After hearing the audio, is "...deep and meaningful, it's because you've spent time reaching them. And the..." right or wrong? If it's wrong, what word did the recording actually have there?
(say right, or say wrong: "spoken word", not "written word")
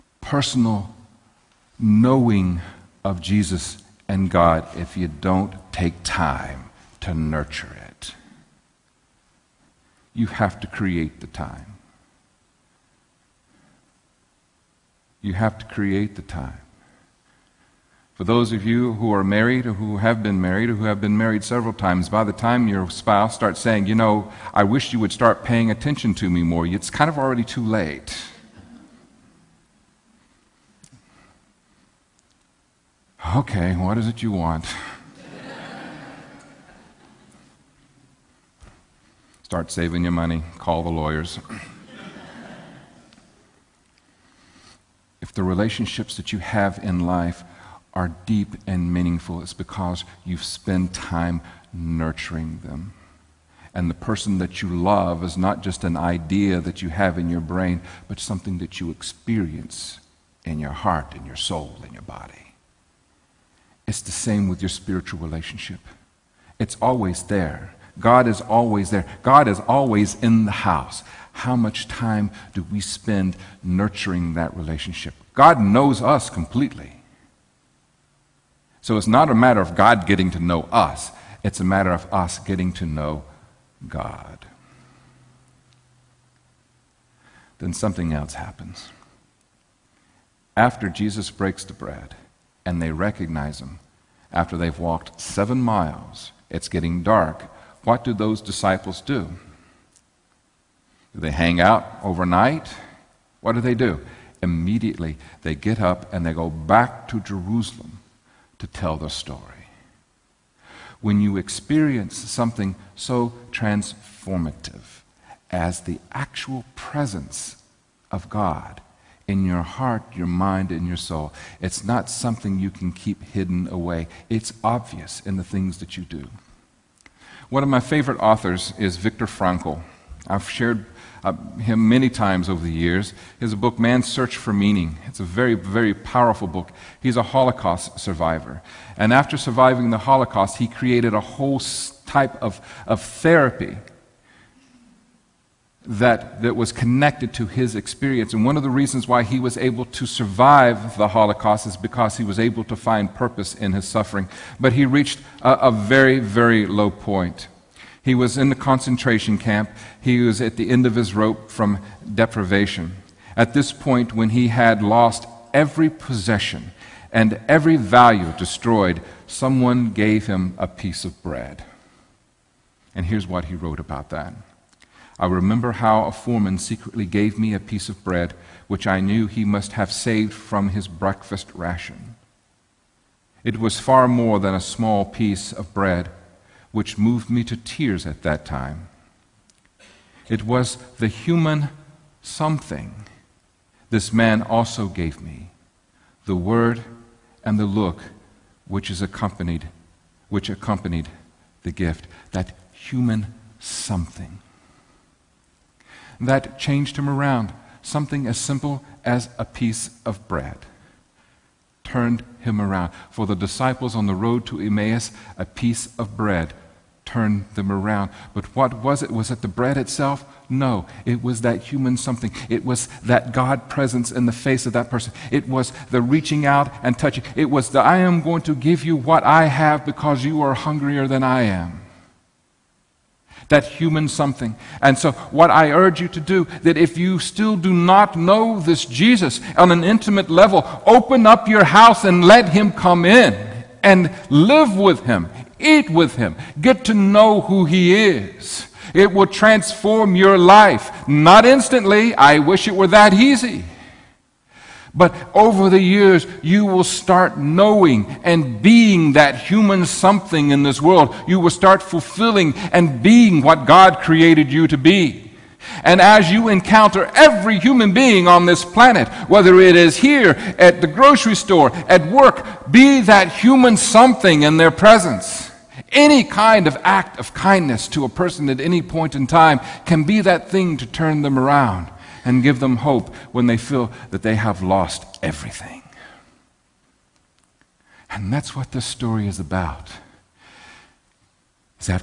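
wrong: "nurturing", not "reaching".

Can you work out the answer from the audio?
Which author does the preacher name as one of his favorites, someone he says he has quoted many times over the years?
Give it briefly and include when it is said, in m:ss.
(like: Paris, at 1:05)
Viktor Frankl, at 2:08.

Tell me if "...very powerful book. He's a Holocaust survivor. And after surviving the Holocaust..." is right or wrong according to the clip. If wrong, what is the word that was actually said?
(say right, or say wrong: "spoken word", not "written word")
right.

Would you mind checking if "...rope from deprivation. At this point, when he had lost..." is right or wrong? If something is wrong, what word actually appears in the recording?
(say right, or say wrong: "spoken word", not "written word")
right.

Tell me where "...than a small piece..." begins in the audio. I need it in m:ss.
3:04.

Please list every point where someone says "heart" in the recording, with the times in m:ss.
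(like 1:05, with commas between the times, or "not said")
1:00, 1:59.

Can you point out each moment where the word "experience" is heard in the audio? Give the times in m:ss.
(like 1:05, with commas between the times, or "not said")
0:58, 1:51, 2:27.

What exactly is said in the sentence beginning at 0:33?
Okay, what is it you want?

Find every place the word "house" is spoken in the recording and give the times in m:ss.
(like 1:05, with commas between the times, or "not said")
1:10, 4:01.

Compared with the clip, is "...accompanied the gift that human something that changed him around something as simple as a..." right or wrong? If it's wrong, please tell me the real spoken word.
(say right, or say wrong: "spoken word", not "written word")
right.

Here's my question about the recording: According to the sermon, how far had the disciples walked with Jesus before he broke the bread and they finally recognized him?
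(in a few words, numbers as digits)
7 miles.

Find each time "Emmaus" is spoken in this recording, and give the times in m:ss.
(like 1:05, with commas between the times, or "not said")
3:34.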